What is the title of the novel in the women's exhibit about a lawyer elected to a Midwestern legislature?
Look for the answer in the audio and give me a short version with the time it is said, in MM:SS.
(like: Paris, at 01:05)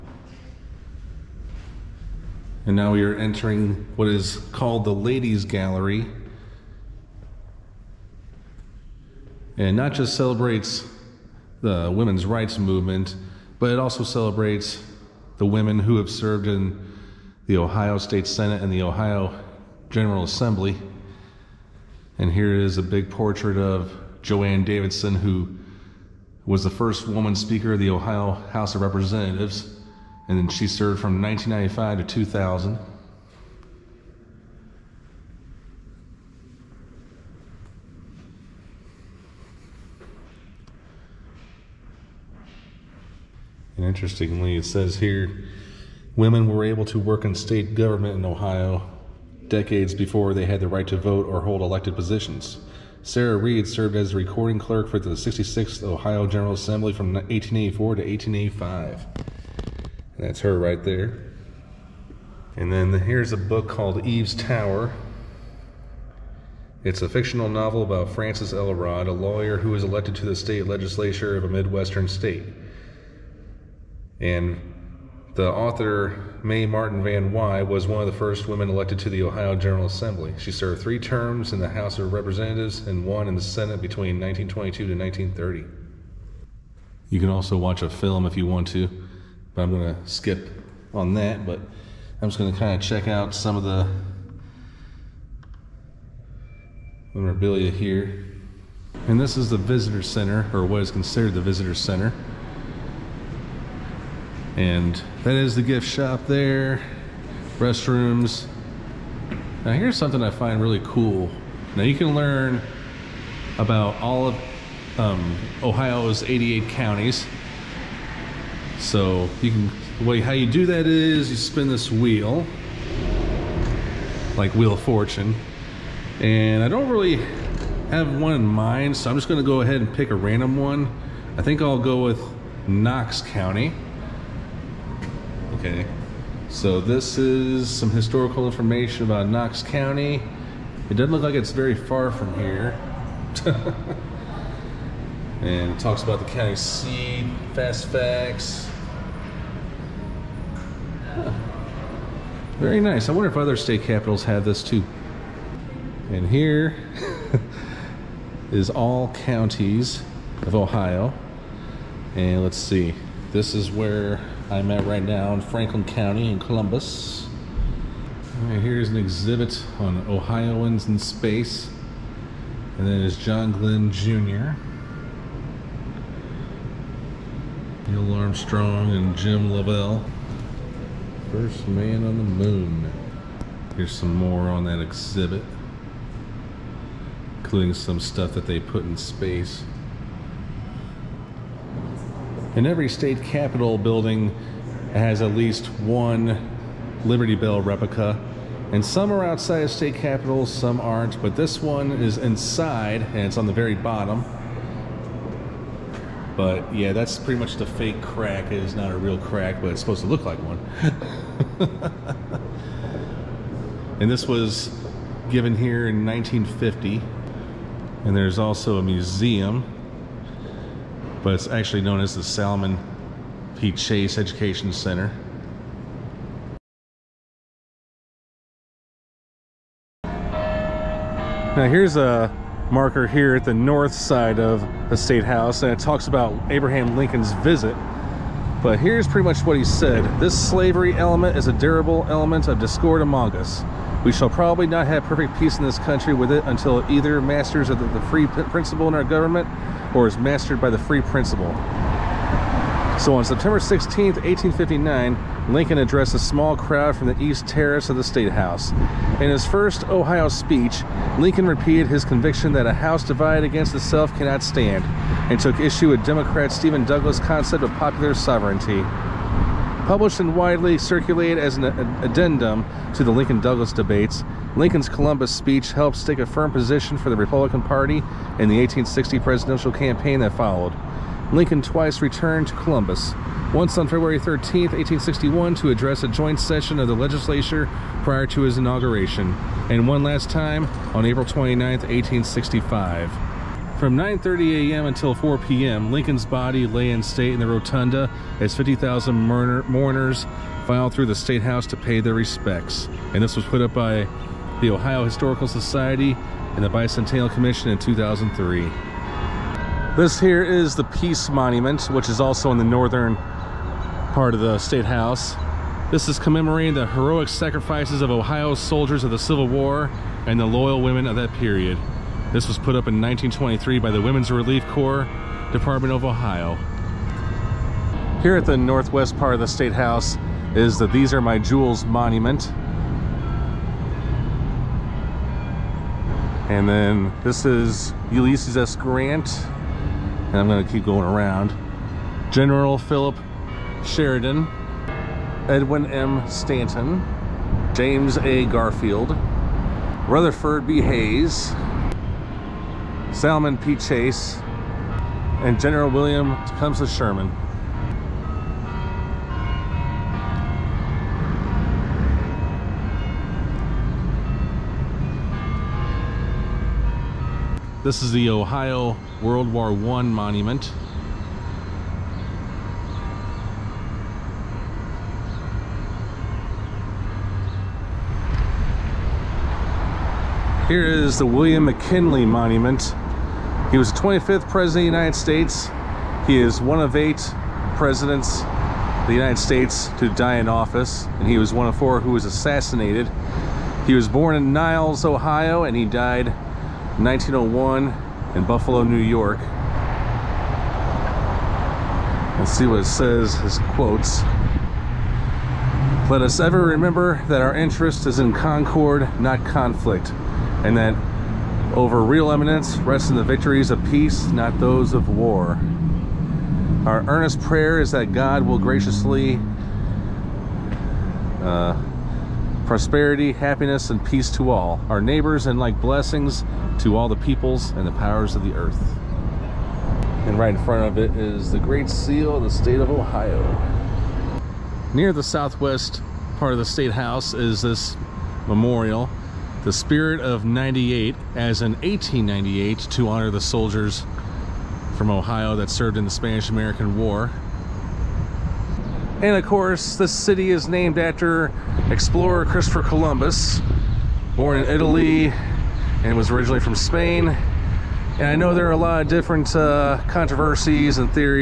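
Eve's Tower, at 01:04.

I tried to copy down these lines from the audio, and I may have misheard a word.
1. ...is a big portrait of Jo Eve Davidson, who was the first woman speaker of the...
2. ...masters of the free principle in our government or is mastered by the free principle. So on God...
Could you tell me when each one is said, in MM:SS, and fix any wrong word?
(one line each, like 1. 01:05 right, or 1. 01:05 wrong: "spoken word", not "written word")
1. 00:22 wrong: "Ann", not "Eve"
2. 04:07 wrong: "September", not "God".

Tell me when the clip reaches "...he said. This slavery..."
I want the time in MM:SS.
03:59.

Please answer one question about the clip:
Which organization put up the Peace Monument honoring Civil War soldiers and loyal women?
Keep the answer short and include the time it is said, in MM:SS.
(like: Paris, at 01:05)
Women's Relief Corps, at 05:24.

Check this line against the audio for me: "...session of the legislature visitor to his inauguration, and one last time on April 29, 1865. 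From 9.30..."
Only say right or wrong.
wrong.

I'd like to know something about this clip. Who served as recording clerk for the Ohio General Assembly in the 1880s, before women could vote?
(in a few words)
Sarah Reed.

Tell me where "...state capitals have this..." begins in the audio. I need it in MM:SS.
02:33.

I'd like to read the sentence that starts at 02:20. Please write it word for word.
It doesn't look like it's very far from here.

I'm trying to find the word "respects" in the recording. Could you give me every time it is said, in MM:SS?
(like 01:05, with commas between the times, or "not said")
05:02.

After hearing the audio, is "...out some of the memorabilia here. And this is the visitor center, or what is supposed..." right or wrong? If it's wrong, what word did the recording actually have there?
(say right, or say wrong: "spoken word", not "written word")
wrong: "considered", not "supposed".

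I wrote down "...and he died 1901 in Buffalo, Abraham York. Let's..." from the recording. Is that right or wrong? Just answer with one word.
wrong.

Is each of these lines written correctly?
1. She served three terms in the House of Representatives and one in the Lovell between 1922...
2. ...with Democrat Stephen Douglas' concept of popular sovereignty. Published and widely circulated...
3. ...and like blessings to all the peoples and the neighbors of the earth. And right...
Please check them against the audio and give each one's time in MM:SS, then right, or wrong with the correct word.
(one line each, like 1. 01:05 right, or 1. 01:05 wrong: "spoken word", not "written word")
1. 01:20 wrong: "Senate", not "Lovell"
2. 04:25 right
3. 07:05 wrong: "powers", not "neighbors".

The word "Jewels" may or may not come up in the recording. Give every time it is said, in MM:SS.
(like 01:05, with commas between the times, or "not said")
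05:31.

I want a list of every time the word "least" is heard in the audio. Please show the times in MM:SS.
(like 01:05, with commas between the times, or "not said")
03:15.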